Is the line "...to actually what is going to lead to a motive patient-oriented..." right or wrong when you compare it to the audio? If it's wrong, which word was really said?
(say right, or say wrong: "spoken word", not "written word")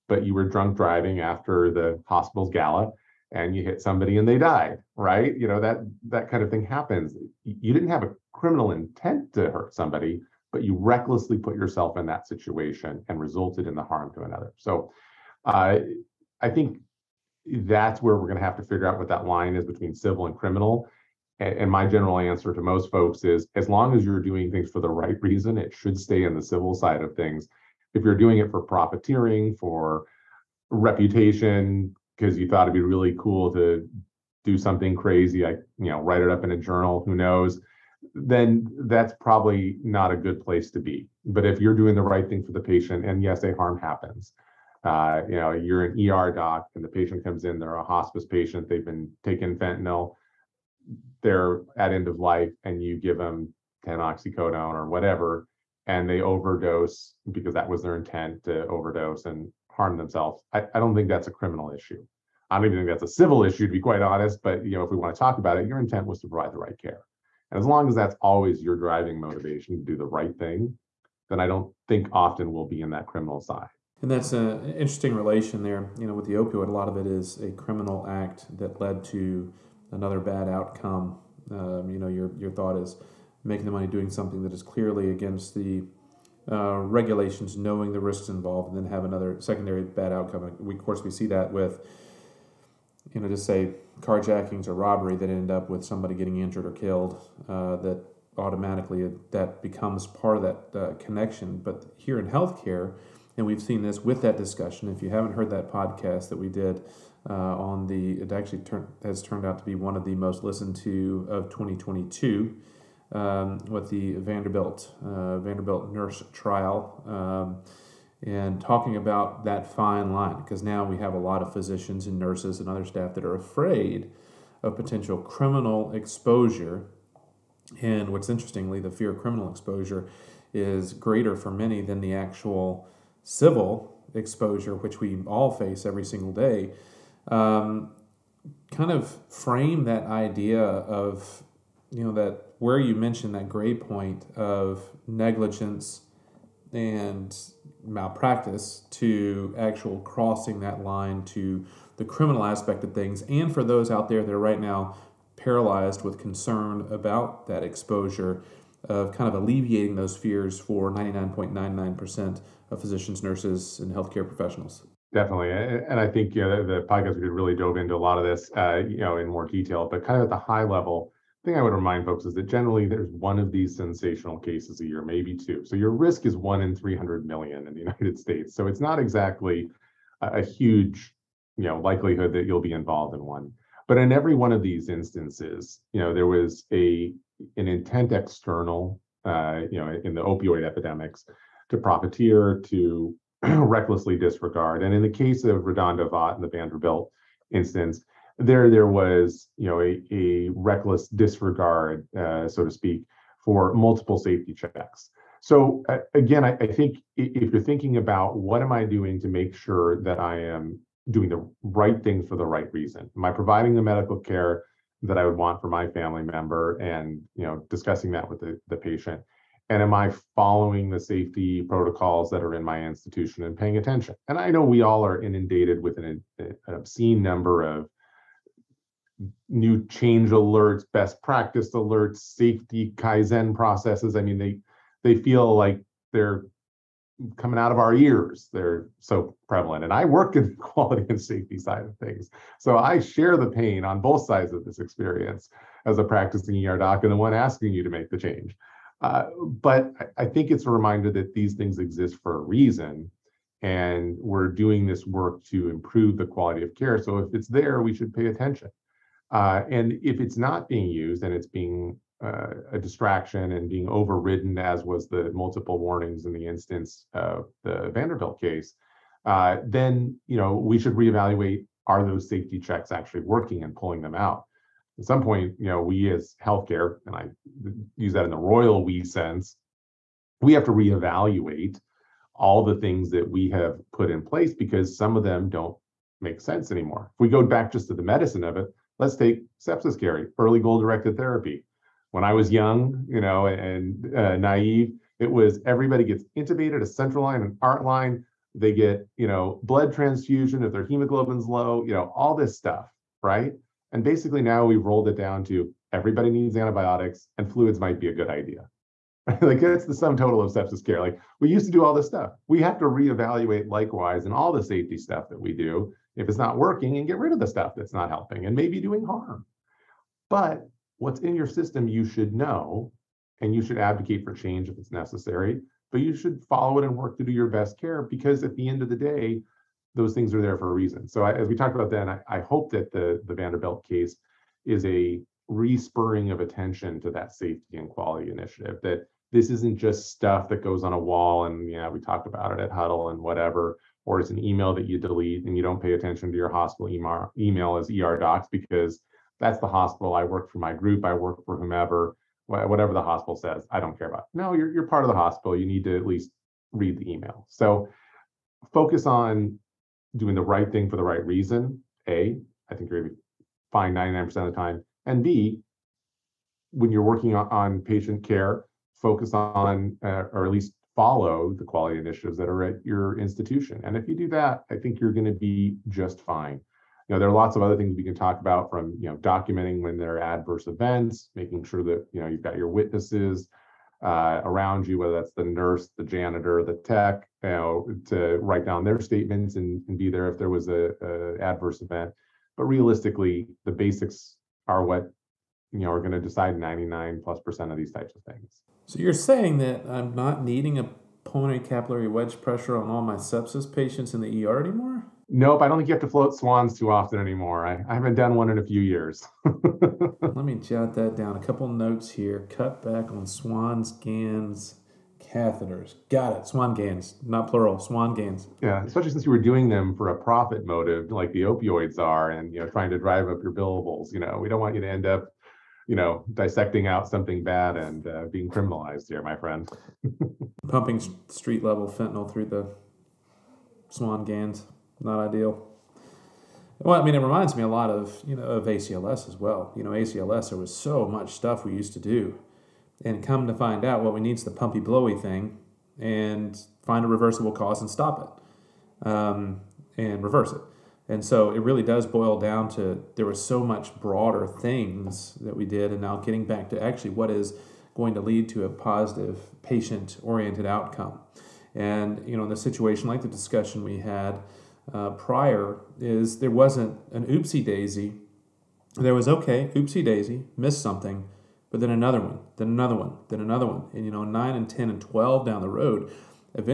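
wrong: "positive", not "motive".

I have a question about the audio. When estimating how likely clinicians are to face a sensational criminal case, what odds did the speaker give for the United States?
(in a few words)
1 in 300 million.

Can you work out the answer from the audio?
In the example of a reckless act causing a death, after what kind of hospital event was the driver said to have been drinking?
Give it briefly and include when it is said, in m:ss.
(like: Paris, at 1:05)
The hospital's gala, at 0:02.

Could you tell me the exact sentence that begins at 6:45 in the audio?
Nope, I don't think you have to float swans too often anymore.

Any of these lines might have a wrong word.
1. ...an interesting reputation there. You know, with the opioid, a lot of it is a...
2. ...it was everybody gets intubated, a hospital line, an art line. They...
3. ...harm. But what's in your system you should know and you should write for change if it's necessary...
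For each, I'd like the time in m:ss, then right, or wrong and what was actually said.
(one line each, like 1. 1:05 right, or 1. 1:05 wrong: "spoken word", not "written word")
1. 1:14 wrong: "relation", not "reputation"
2. 4:55 wrong: "central", not "hospital"
3. 5:19 wrong: "advocate", not "write".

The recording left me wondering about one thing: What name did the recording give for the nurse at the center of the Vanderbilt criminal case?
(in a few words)
Redondo Vaught.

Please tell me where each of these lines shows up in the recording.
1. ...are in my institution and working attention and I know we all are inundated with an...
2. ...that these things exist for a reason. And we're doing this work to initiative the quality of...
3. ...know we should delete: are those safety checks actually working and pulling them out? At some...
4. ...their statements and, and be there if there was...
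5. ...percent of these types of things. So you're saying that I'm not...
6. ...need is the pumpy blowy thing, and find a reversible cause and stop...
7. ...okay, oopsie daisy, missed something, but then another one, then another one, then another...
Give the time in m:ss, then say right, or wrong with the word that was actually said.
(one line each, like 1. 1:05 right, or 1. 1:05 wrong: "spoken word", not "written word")
1. 3:42 wrong: "paying", not "working"
2. 4:11 wrong: "improve", not "initiative"
3. 4:30 wrong: "reevaluate", not "delete"
4. 6:28 right
5. 6:37 right
6. 7:24 right
7. 7:49 right.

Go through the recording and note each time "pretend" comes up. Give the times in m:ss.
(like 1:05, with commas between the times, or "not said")
not said.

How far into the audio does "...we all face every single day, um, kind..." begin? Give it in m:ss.
2:14.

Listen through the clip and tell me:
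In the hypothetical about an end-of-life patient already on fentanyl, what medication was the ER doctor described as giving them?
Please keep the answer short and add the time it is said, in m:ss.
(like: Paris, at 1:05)
Oxycodone, at 0:53.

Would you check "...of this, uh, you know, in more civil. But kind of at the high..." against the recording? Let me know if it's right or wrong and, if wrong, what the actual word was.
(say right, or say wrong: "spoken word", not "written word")
wrong: "detail", not "civil".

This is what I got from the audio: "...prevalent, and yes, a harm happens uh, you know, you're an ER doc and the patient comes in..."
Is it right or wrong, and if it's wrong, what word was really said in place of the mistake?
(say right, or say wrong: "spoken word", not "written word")
wrong: "patient", not "prevalent".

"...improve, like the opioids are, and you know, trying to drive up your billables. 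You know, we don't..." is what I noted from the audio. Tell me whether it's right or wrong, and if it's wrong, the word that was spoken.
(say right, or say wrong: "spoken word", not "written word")
wrong: "motive", not "improve".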